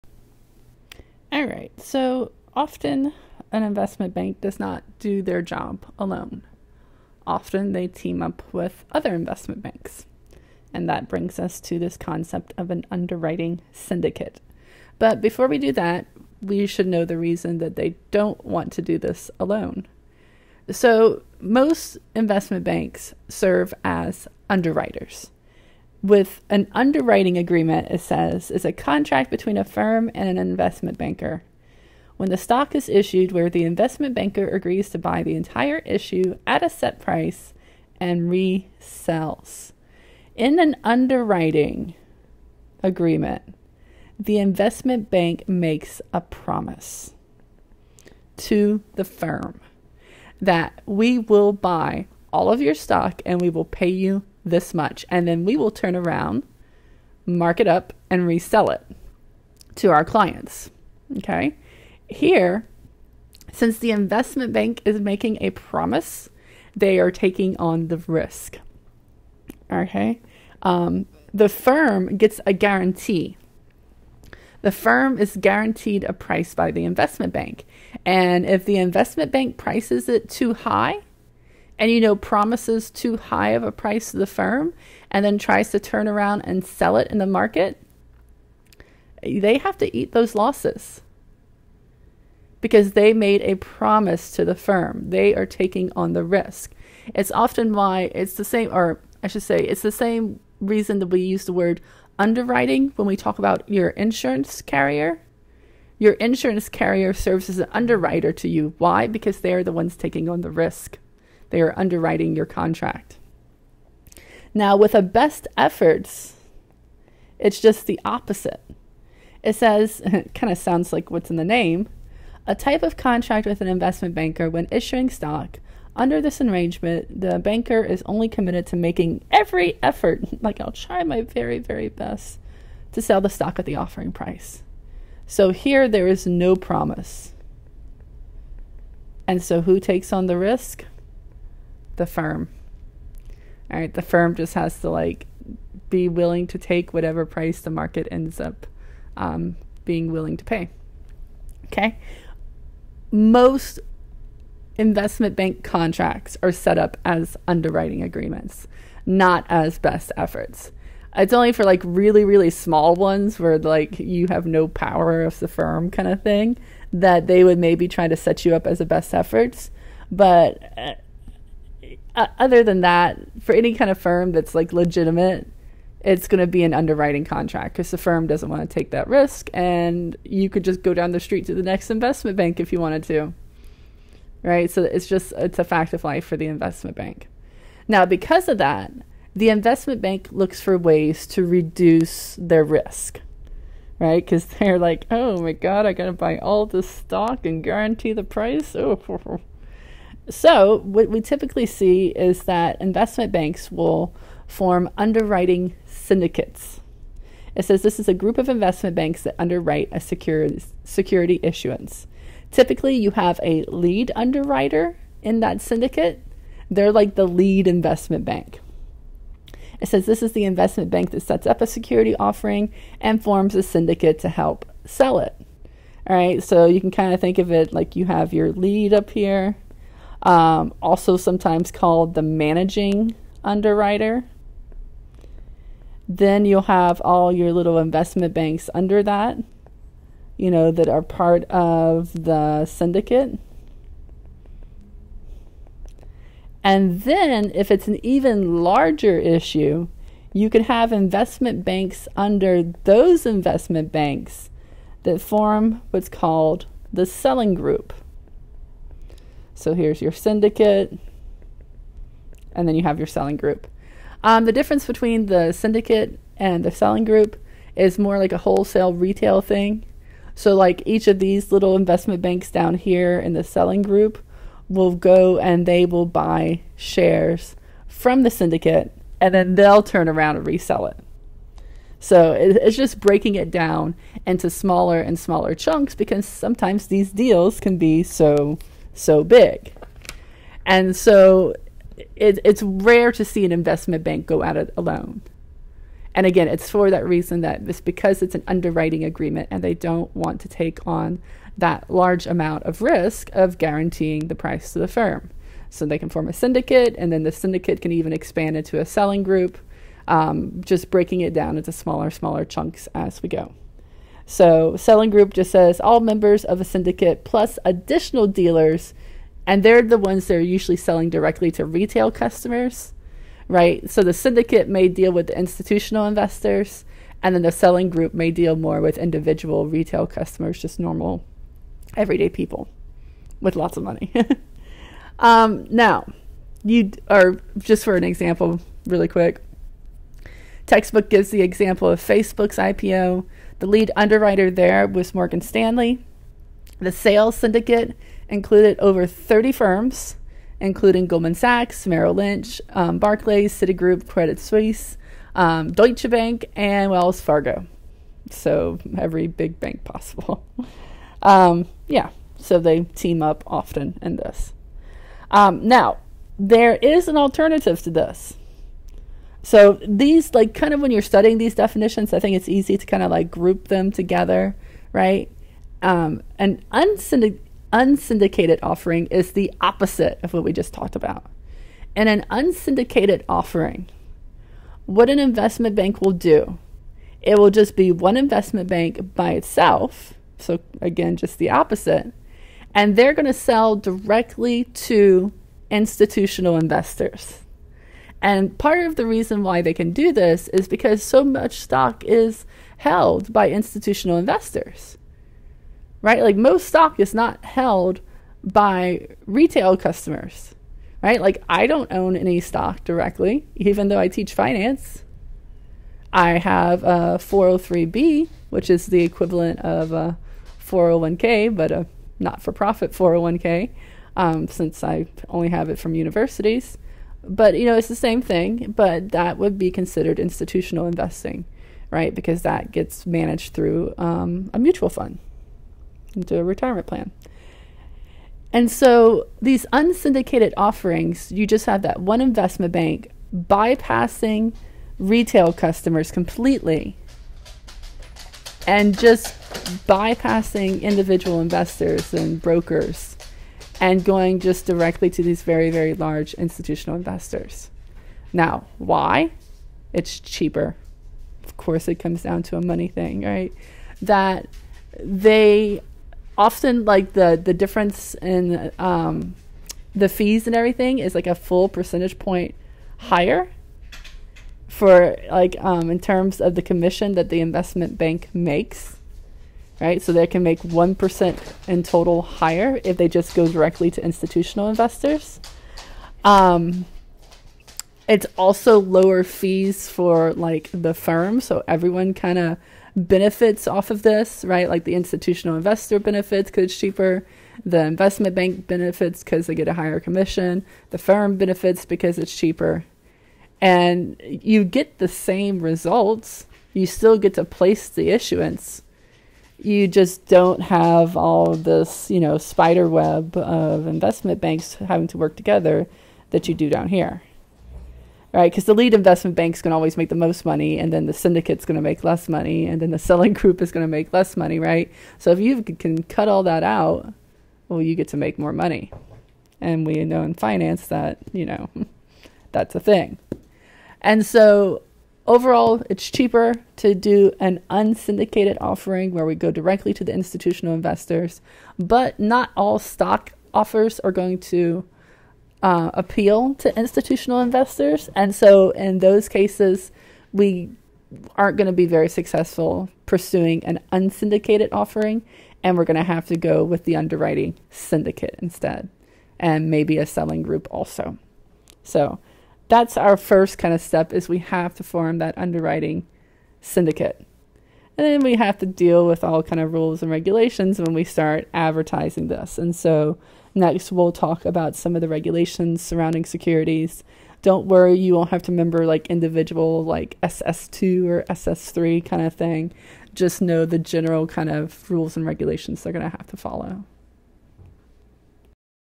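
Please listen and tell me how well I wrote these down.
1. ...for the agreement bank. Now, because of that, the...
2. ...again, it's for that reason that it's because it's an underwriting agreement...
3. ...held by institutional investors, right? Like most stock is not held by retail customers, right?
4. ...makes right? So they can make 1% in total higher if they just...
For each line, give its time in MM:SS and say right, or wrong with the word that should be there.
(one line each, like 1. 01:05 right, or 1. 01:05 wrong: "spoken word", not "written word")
1. 03:06 wrong: "investment", not "agreement"
2. 04:56 right
3. 06:42 right
4. 07:58 right.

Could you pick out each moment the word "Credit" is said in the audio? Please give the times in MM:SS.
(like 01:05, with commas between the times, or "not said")
05:54.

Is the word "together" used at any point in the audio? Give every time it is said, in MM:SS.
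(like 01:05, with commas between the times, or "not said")
06:13, 08:35.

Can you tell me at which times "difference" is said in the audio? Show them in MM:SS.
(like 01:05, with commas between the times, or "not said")
04:24, 07:47.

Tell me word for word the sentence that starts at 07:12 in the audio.
Because that gets managed through um, a mutual fund into a retirement plan.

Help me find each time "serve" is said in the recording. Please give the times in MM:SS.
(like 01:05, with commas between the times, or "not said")
00:23, 01:47.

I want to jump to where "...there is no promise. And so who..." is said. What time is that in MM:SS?
02:15.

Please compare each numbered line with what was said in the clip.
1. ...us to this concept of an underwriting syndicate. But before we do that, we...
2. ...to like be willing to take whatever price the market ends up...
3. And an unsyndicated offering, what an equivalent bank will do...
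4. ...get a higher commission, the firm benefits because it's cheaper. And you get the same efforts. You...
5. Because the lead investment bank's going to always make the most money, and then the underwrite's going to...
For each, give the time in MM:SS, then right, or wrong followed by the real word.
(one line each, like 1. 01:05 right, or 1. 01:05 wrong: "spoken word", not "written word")
1. 00:11 right
2. 02:24 right
3. 06:21 wrong: "investment", not "equivalent"
4. 08:19 wrong: "results", not "efforts"
5. 08:38 wrong: "syndicate", not "underwrite".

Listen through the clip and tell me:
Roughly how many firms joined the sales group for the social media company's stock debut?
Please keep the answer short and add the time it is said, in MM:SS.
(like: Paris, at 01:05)
over 30, at 05:48.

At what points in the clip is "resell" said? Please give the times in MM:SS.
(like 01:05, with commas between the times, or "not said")
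00:38, 00:58, 04:40.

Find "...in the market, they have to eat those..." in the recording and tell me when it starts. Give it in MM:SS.
01:27.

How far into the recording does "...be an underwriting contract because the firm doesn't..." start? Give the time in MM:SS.
02:56.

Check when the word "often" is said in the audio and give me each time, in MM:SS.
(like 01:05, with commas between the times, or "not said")
00:02, 00:07, 01:37, 06:03, 07:46.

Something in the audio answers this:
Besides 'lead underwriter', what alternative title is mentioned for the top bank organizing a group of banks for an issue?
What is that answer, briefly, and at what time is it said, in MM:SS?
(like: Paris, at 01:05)
managing underwriter, at 03:52.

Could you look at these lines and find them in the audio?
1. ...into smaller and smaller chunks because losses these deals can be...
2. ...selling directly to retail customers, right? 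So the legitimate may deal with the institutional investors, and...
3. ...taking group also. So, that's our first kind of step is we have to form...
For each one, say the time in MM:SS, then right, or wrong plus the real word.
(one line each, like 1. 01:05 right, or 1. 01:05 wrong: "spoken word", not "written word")
1. 04:44 wrong: "sometimes", not "losses"
2. 05:20 wrong: "syndicate", not "legitimate"
3. 09:20 wrong: "selling", not "taking".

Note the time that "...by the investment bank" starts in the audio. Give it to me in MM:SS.
01:16.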